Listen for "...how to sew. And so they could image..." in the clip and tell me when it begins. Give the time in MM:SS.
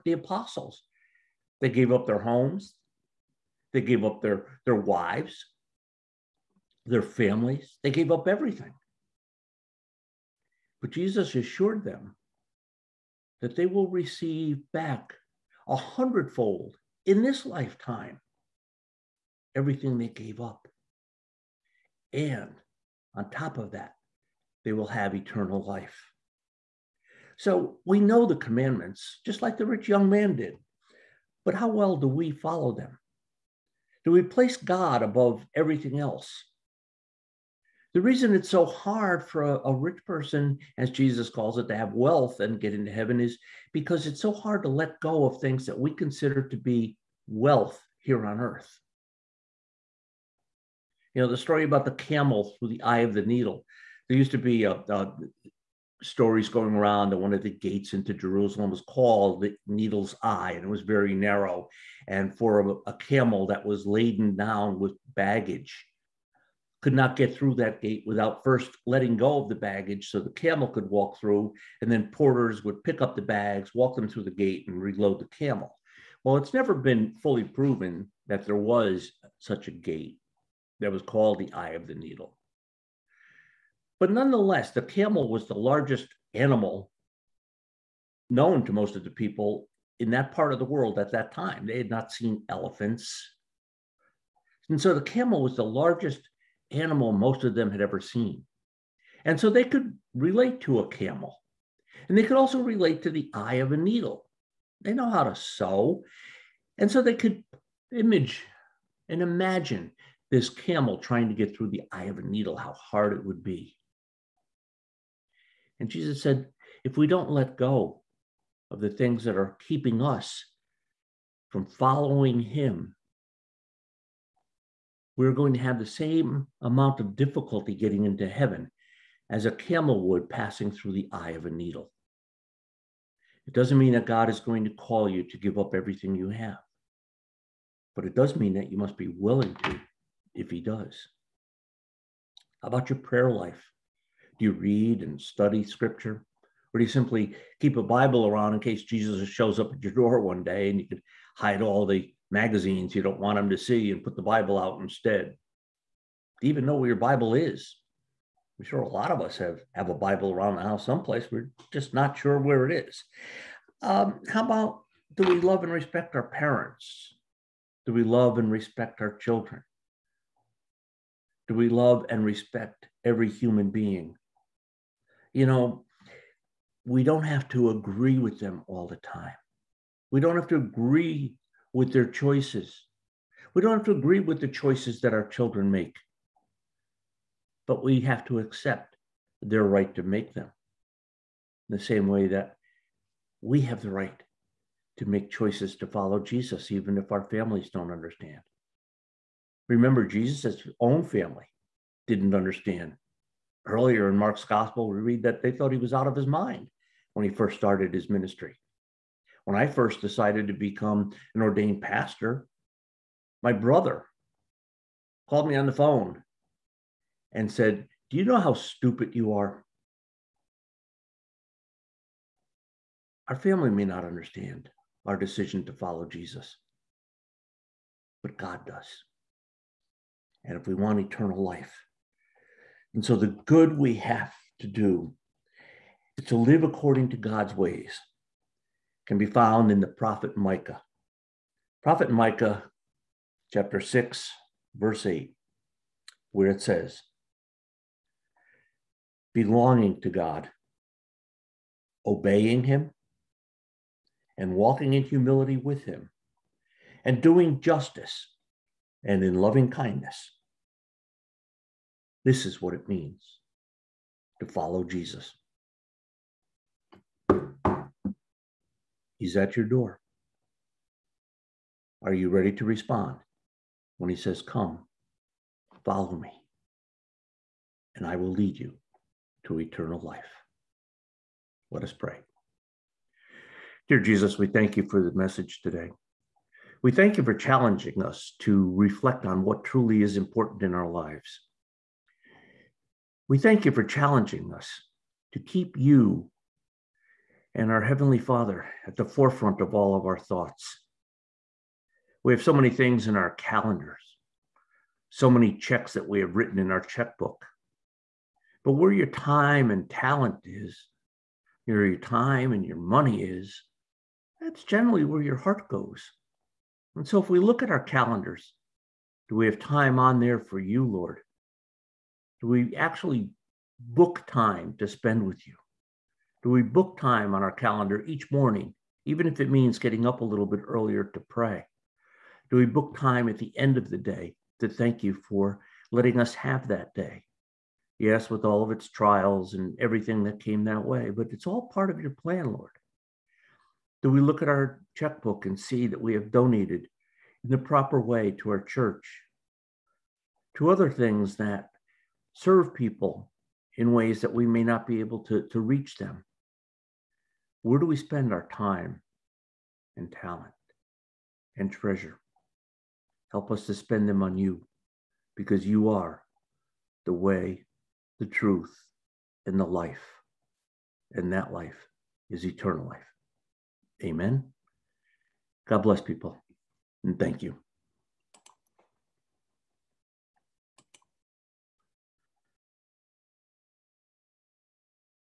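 01:45.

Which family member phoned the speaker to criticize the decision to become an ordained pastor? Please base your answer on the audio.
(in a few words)
brother.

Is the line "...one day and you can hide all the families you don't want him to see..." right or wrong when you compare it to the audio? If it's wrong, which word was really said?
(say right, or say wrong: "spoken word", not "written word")
wrong: "magazines", not "families".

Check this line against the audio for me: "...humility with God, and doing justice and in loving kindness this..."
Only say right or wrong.
wrong.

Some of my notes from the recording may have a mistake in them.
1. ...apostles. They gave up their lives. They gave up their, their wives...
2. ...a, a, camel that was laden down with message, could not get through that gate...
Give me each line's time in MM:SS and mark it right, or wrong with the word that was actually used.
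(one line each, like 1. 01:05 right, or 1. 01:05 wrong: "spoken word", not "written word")
1. 00:00 wrong: "homes", not "lives"
2. 01:02 wrong: "baggage", not "message".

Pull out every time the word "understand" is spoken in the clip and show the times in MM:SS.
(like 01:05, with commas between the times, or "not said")
03:17, 03:22, 03:44.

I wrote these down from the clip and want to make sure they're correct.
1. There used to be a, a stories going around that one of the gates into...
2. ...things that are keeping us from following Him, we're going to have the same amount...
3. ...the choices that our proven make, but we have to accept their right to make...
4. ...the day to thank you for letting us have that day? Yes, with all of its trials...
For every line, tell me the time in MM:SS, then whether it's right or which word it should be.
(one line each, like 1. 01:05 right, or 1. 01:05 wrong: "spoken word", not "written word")
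1. 00:54 right
2. 01:58 right
3. 03:04 wrong: "children", not "proven"
4. 05:33 right.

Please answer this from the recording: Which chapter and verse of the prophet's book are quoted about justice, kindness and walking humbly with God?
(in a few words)
chapter 6, verse 8.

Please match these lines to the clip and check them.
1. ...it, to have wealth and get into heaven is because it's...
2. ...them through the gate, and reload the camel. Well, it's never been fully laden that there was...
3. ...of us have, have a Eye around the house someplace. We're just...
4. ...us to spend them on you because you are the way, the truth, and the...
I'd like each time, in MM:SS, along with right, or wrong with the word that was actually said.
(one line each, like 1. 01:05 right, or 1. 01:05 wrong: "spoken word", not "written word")
1. 00:41 right
2. 01:13 wrong: "proven", not "laden"
3. 02:39 wrong: "Bible", not "Eye"
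4. 06:03 right.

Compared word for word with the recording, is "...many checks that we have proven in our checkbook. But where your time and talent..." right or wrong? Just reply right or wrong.
wrong.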